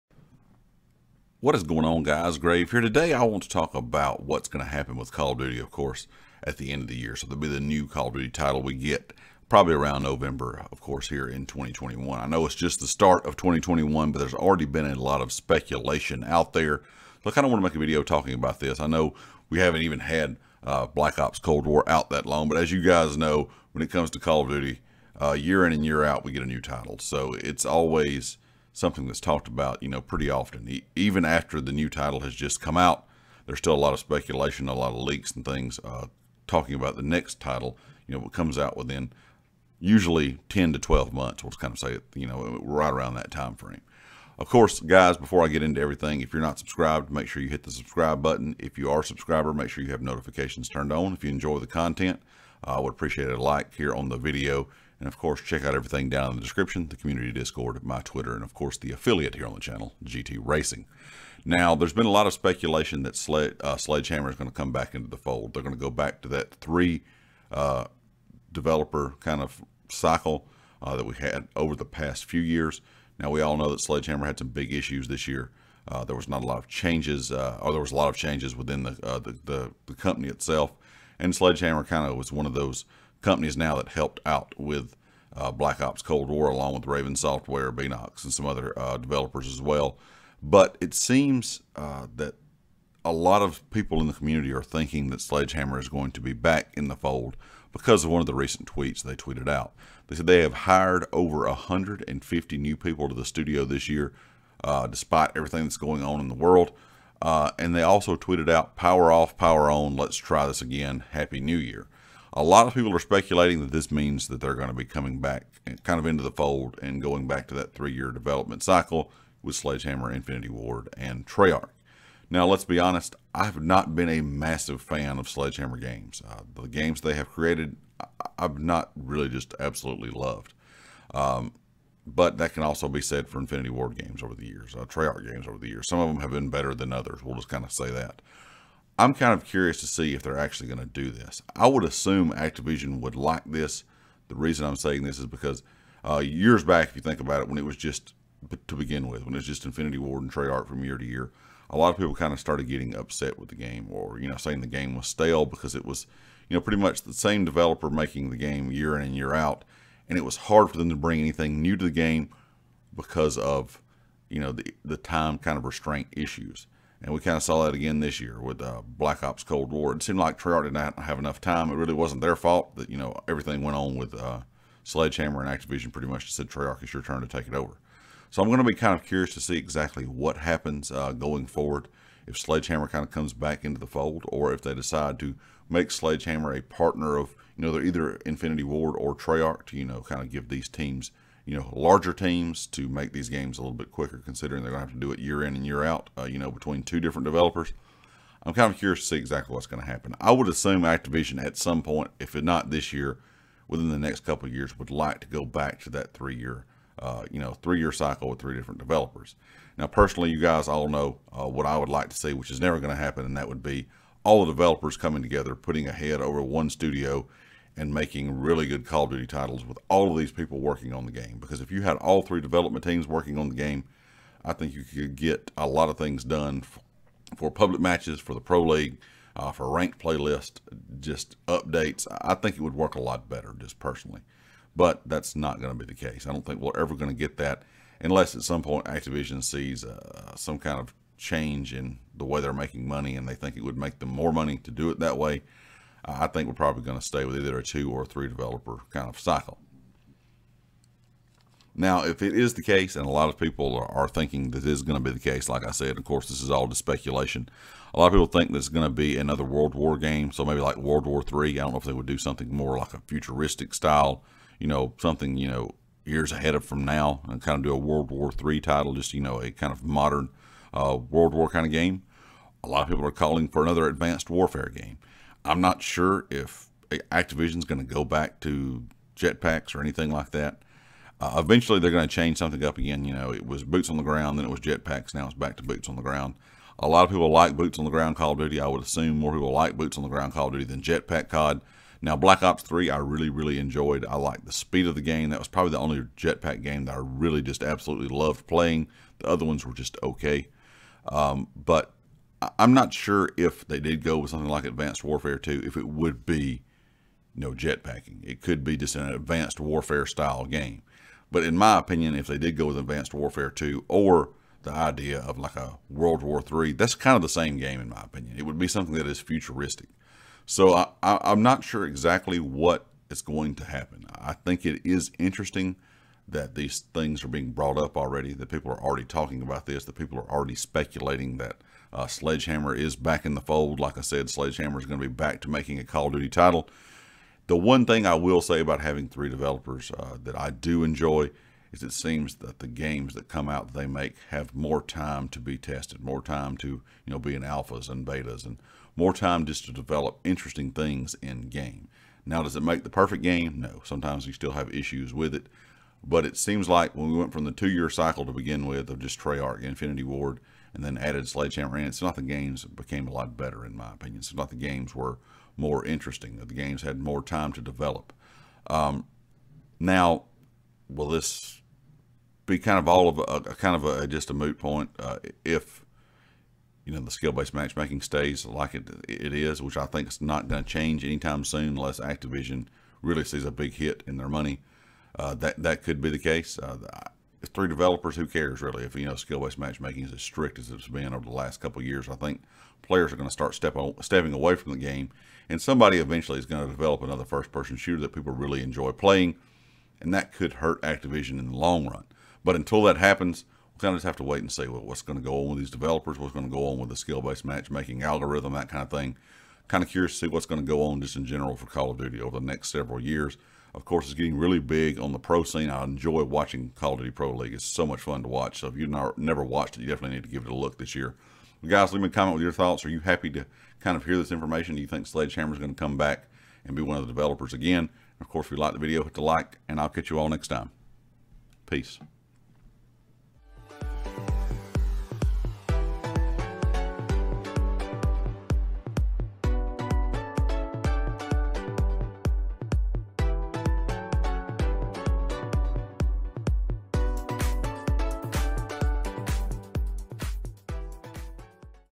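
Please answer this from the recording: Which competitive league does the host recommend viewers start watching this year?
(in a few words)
Call of Duty Pro League.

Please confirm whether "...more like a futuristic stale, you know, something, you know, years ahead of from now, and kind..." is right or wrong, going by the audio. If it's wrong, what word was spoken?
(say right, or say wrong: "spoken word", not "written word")
wrong: "style", not "stale".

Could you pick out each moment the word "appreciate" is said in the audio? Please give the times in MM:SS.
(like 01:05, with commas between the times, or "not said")
00:52.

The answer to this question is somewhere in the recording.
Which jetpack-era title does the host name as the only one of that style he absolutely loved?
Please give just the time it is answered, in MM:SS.
04:52.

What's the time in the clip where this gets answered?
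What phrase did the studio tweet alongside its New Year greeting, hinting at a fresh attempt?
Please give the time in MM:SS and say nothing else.
01:48.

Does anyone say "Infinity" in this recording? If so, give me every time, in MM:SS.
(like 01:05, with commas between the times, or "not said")
02:00, 02:13, 02:29, 03:08, 05:59.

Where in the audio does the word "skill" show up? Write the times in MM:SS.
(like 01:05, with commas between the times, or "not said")
06:17, 06:29, 06:46.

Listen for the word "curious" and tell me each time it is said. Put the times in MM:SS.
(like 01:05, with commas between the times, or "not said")
02:19, 02:59, 03:18, 06:49.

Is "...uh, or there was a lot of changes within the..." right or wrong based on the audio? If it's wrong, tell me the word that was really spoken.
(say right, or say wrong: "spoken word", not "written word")
right.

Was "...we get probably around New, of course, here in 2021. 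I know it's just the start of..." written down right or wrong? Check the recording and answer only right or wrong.
wrong.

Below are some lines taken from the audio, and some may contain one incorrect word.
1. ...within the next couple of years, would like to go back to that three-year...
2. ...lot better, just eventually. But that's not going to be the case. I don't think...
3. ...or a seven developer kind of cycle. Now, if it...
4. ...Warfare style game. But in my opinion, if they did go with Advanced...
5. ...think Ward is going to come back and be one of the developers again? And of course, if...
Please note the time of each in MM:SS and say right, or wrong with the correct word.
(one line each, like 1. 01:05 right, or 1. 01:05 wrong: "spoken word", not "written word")
1. 03:23 right
2. 03:53 wrong: "personally", not "eventually"
3. 04:07 wrong: "three", not "seven"
4. 05:09 right
5. 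07:04 wrong: "Sledgehammer", not "Ward".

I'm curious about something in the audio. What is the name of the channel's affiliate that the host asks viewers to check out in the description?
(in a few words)
GT Racing.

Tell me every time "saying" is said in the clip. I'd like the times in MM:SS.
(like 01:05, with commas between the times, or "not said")
02:24, 02:34.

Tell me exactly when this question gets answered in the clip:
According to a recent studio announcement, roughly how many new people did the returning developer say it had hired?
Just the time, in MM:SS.
01:41.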